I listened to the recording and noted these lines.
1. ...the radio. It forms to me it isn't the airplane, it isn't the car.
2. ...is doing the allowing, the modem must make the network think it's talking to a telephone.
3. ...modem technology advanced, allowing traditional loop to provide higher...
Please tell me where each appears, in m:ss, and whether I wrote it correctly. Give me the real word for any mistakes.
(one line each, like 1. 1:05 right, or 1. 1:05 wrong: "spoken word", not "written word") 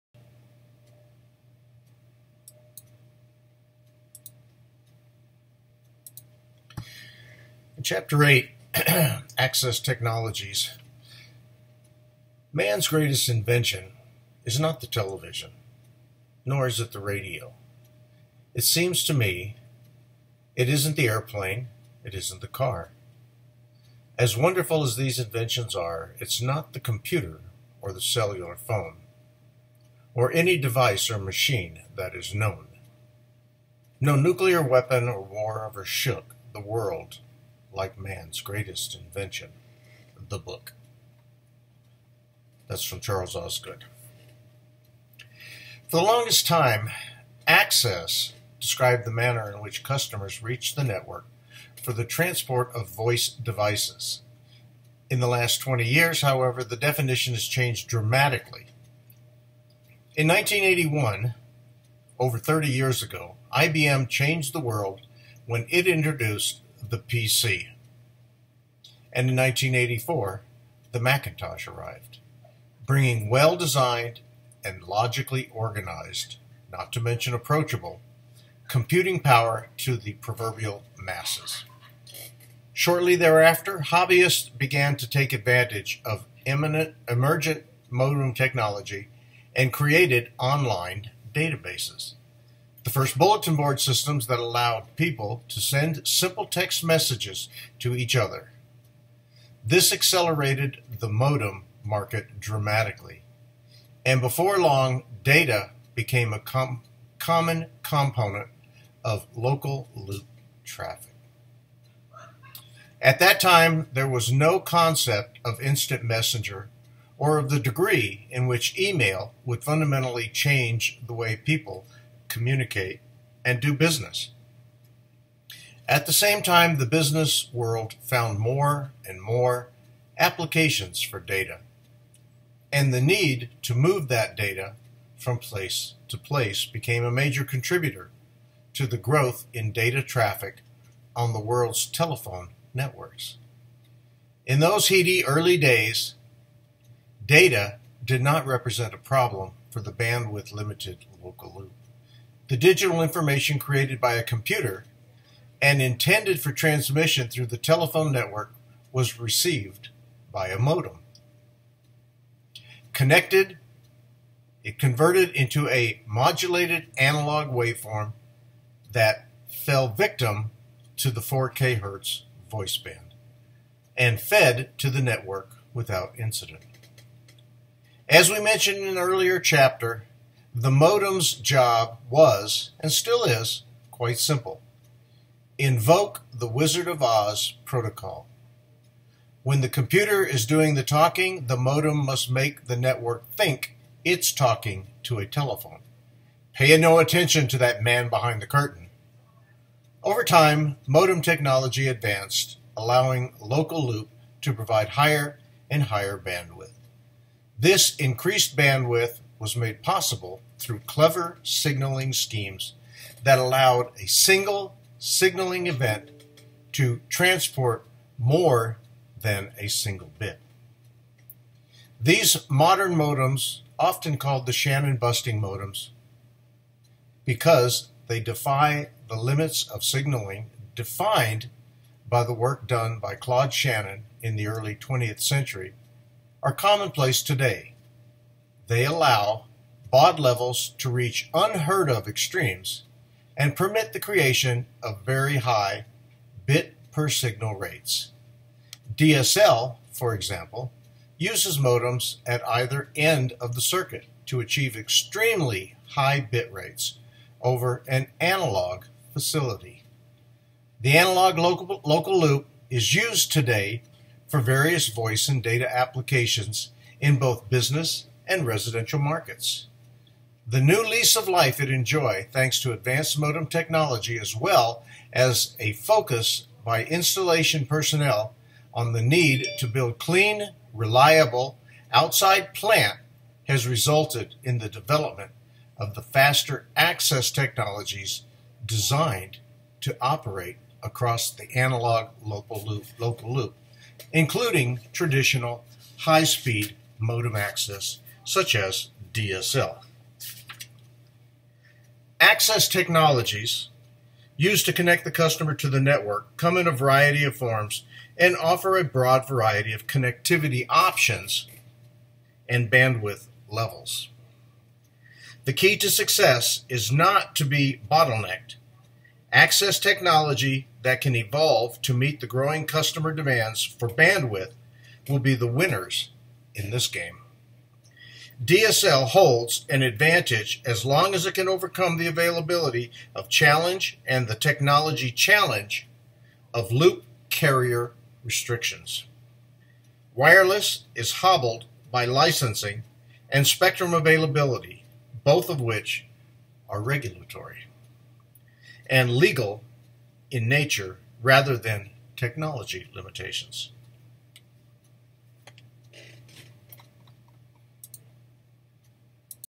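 1. 0:16 wrong: "seems", not "forms"
2. 3:10 wrong: "talking", not "allowing"
3. 3:20 wrong: "local", not "traditional".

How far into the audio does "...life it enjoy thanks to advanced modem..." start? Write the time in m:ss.
4:31.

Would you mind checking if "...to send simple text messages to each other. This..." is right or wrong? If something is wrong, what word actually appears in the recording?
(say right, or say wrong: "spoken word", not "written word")
right.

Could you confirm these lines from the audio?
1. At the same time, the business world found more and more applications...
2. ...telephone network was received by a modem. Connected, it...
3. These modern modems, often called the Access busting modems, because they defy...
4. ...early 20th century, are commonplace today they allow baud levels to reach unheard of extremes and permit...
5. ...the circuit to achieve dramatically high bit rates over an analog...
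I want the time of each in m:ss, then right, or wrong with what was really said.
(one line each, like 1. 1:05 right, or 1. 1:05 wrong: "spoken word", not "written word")
1. 2:05 right
2. 2:37 right
3. 3:41 wrong: "Shannon", not "Access"
4. 3:54 right
5. 4:13 wrong: "extremely", not "dramatically".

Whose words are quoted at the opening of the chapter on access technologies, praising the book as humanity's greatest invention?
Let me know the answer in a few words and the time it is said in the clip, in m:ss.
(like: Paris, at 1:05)
Charles Osgood, at 0:42.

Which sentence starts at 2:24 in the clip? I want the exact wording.
In those heady early days, data did not represent a problem for the bandwidth limited local loop.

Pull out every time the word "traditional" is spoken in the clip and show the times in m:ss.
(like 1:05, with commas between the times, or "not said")
4:54.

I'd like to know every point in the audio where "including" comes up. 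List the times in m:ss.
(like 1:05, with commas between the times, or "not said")
4:54.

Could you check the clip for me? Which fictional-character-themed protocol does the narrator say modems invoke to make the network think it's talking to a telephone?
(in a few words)
Wizard of Oz protocol.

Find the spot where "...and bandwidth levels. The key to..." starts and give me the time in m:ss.
5:12.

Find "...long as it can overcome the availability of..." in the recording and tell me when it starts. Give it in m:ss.
5:30.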